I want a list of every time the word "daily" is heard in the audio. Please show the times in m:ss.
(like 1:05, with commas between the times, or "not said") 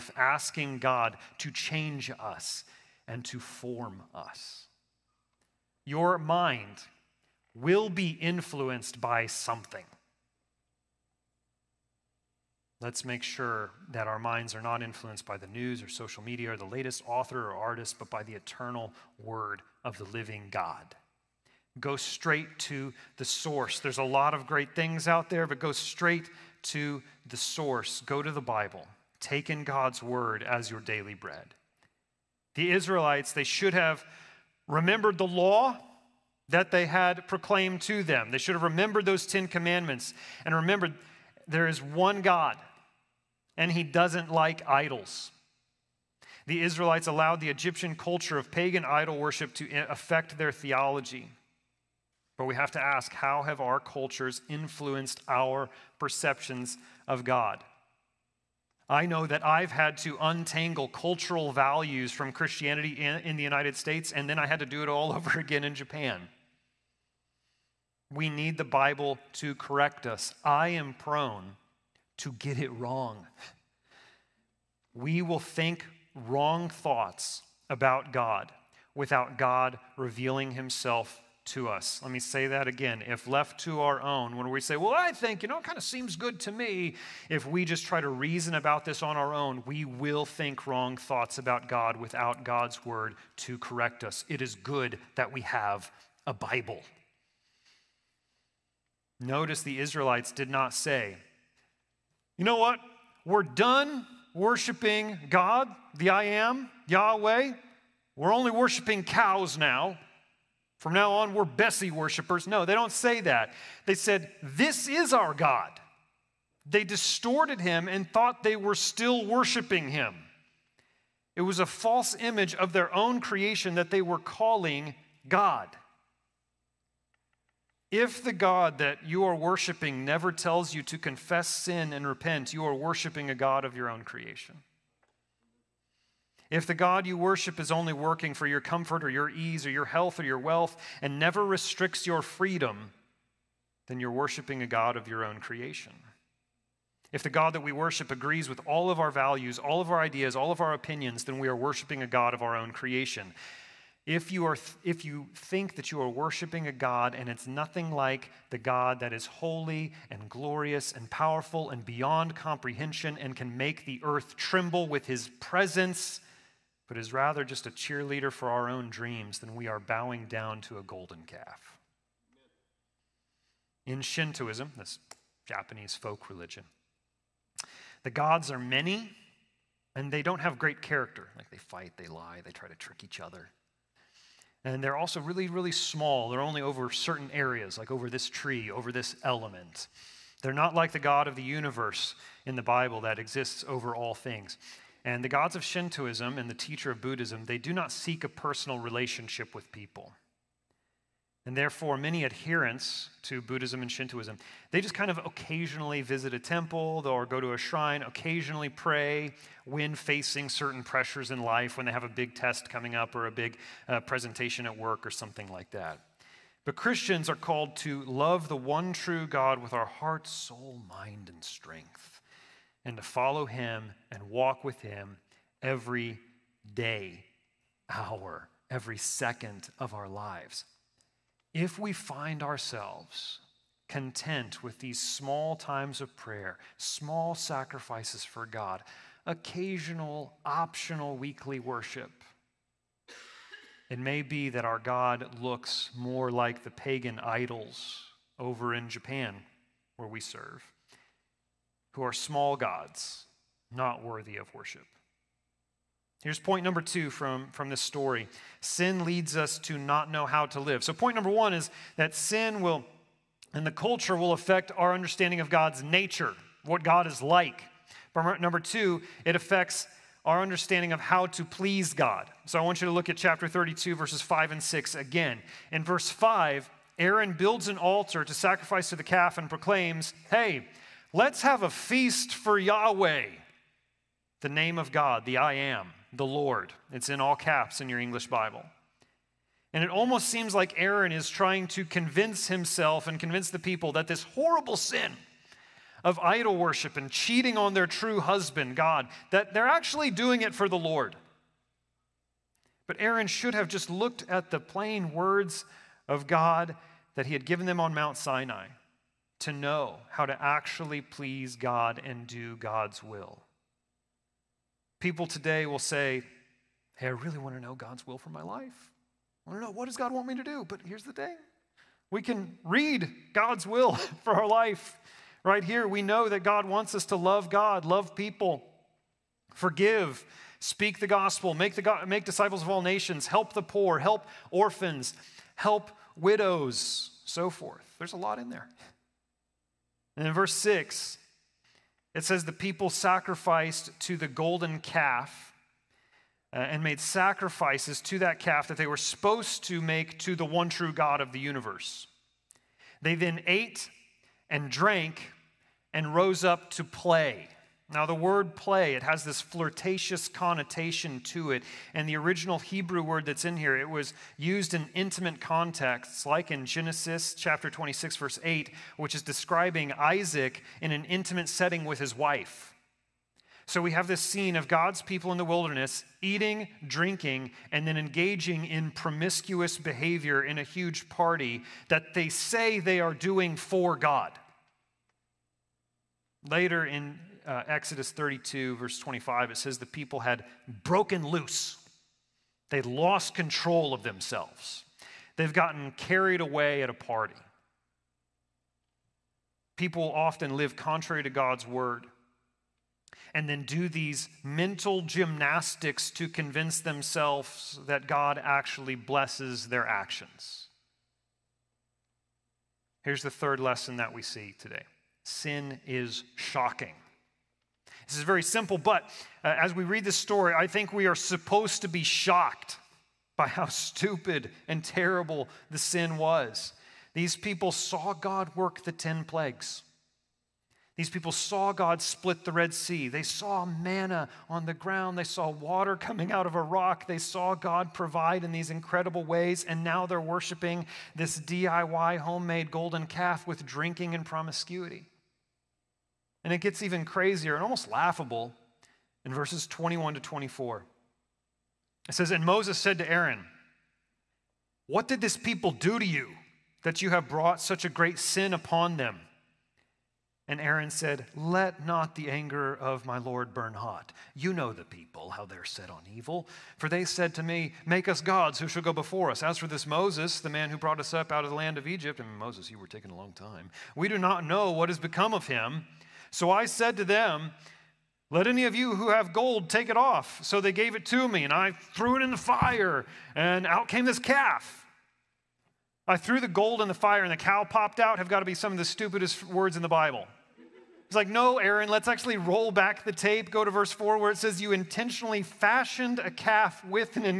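0:30.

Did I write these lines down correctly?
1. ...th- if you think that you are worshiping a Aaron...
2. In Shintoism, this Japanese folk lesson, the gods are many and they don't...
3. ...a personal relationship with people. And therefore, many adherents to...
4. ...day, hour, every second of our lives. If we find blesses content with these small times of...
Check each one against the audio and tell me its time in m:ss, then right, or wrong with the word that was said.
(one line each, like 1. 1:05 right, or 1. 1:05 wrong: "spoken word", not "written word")
1. 2:34 wrong: "God", not "Aaron"
2. 2:53 wrong: "religion", not "lesson"
3. 3:18 right
4. 3:46 wrong: "ourselves", not "blesses".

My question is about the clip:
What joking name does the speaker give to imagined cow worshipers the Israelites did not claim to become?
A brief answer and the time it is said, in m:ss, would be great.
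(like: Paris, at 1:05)
Bessie worshipers, at 1:51.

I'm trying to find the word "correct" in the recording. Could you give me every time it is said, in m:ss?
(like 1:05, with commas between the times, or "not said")
1:09, 1:33.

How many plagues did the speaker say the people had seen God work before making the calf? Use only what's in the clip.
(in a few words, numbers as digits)
10.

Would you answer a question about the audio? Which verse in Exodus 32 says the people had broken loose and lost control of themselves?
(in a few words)
Verse 25.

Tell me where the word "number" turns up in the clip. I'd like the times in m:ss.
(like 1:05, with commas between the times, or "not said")
4:16, 4:21, 4:28.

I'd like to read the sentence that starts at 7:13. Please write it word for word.
They saw manna on the ground.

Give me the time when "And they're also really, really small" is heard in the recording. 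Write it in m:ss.
3:04.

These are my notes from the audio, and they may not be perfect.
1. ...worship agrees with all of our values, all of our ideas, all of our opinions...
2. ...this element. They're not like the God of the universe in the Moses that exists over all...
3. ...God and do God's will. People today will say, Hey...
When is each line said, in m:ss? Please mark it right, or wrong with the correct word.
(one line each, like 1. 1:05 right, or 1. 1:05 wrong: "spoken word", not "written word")
1. 2:27 right
2. 3:08 wrong: "Bible", not "Moses"
3. 5:11 right.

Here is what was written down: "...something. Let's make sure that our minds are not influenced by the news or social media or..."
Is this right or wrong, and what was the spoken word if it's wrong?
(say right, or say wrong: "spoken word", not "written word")
right.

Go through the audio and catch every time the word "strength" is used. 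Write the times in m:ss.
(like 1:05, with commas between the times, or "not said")
3:41.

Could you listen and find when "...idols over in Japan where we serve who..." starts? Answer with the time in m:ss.
4:07.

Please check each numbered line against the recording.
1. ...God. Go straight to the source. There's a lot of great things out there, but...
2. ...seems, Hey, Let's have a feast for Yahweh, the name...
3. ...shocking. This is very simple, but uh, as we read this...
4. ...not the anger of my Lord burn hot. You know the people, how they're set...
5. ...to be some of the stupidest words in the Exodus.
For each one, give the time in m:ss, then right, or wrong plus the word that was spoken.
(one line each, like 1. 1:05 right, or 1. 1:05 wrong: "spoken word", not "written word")
1. 0:20 right
2. 4:39 wrong: "proclaims", not "seems"
3. 6:56 right
4. 7:41 right
5. 8:08 wrong: "Bible", not "Exodus".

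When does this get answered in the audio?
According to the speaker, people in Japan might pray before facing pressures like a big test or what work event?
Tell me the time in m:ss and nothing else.
3:34.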